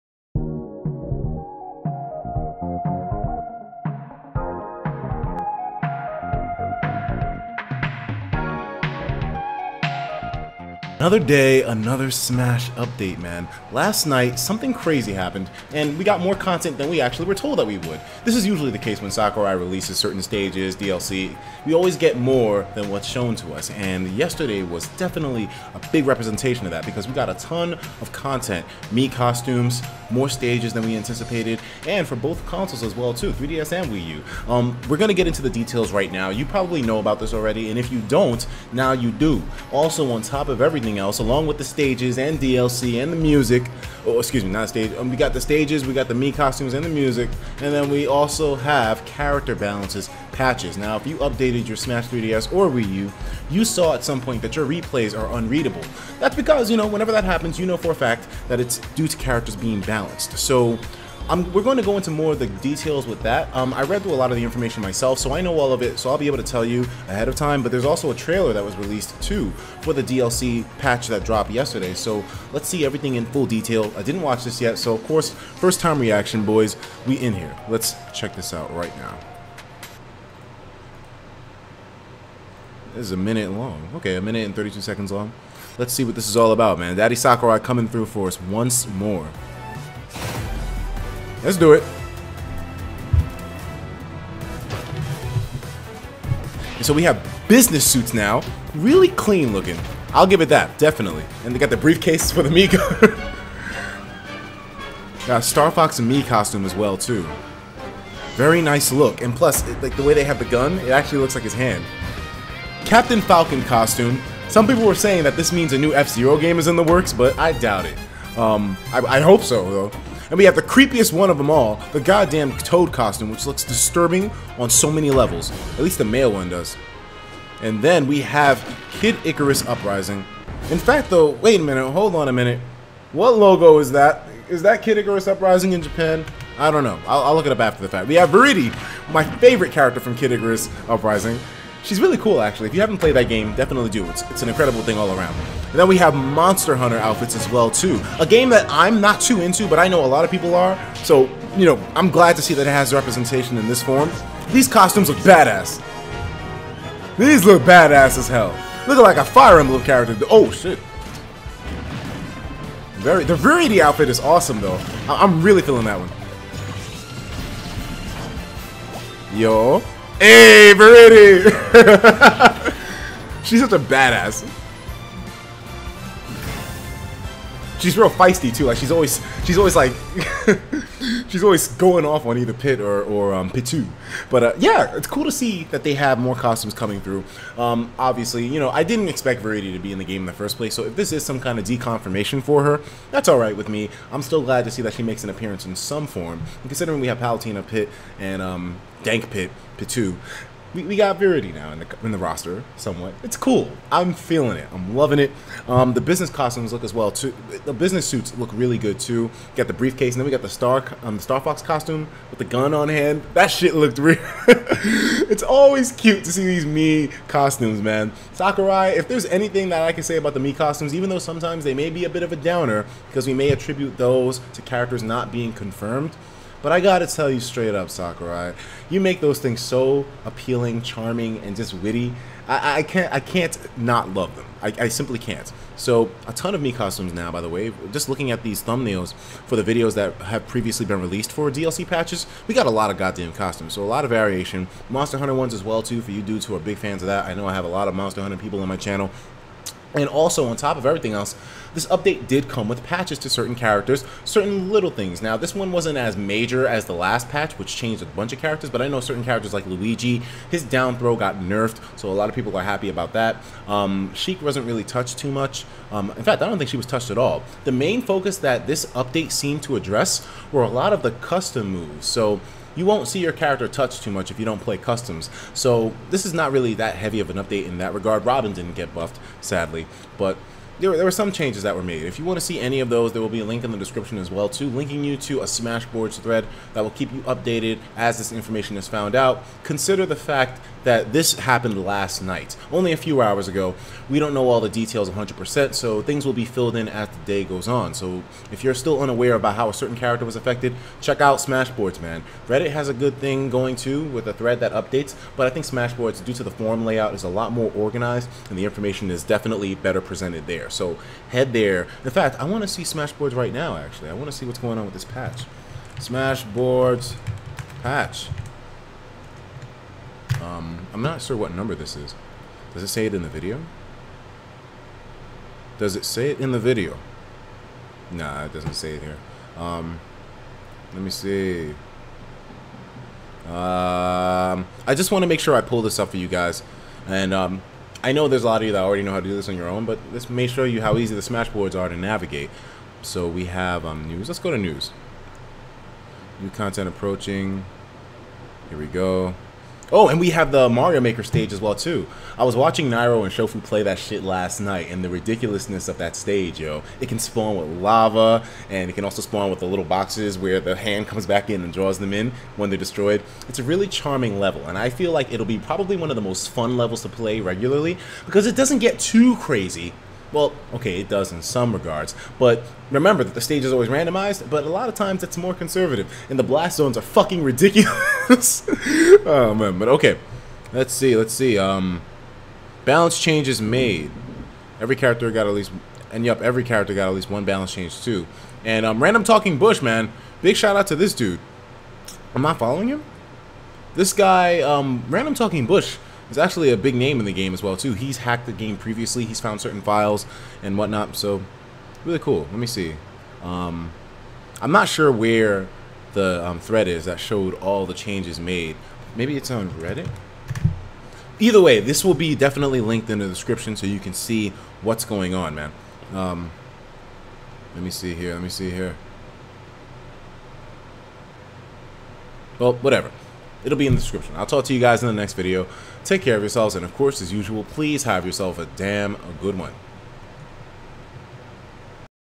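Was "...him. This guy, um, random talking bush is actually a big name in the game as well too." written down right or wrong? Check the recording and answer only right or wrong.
right.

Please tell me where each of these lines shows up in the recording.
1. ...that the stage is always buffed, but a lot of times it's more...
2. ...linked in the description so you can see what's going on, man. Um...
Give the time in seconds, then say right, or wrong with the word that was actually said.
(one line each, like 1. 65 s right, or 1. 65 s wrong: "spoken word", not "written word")
1. 373 s wrong: "randomized", not "buffed"
2. 412 s right.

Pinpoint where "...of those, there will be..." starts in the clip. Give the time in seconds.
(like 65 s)
282 s.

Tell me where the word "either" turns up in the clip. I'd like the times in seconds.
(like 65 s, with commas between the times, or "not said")
182 s, 411 s.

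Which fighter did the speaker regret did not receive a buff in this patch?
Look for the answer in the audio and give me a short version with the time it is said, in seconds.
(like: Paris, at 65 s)
Robin, at 278 s.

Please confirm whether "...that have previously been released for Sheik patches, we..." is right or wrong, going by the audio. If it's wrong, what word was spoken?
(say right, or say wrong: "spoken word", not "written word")
wrong: "DLC", not "Sheik".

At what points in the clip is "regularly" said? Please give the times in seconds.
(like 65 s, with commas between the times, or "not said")
367 s.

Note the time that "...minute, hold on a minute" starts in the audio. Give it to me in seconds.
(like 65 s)
131 s.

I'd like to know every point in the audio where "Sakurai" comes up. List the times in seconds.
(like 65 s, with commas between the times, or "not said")
19 s, 87 s, 218 s, 227 s.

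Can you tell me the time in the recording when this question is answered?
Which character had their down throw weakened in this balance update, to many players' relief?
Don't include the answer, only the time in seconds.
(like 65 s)
259 s.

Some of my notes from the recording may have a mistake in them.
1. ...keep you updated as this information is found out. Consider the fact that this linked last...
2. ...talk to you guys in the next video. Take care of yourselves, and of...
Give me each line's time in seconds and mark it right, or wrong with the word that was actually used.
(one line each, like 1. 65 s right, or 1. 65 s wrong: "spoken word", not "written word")
1. 286 s wrong: "happened", not "linked"
2. 424 s right.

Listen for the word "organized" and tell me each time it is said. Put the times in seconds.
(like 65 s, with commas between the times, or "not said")
307 s.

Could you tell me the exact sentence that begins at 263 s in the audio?
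Um, Sheik wasn't really touched too much.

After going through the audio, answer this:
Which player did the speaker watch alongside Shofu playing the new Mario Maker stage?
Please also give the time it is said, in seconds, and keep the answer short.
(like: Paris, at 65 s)
Nairo, at 352 s.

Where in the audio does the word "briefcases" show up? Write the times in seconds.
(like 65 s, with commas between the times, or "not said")
101 s, 209 s.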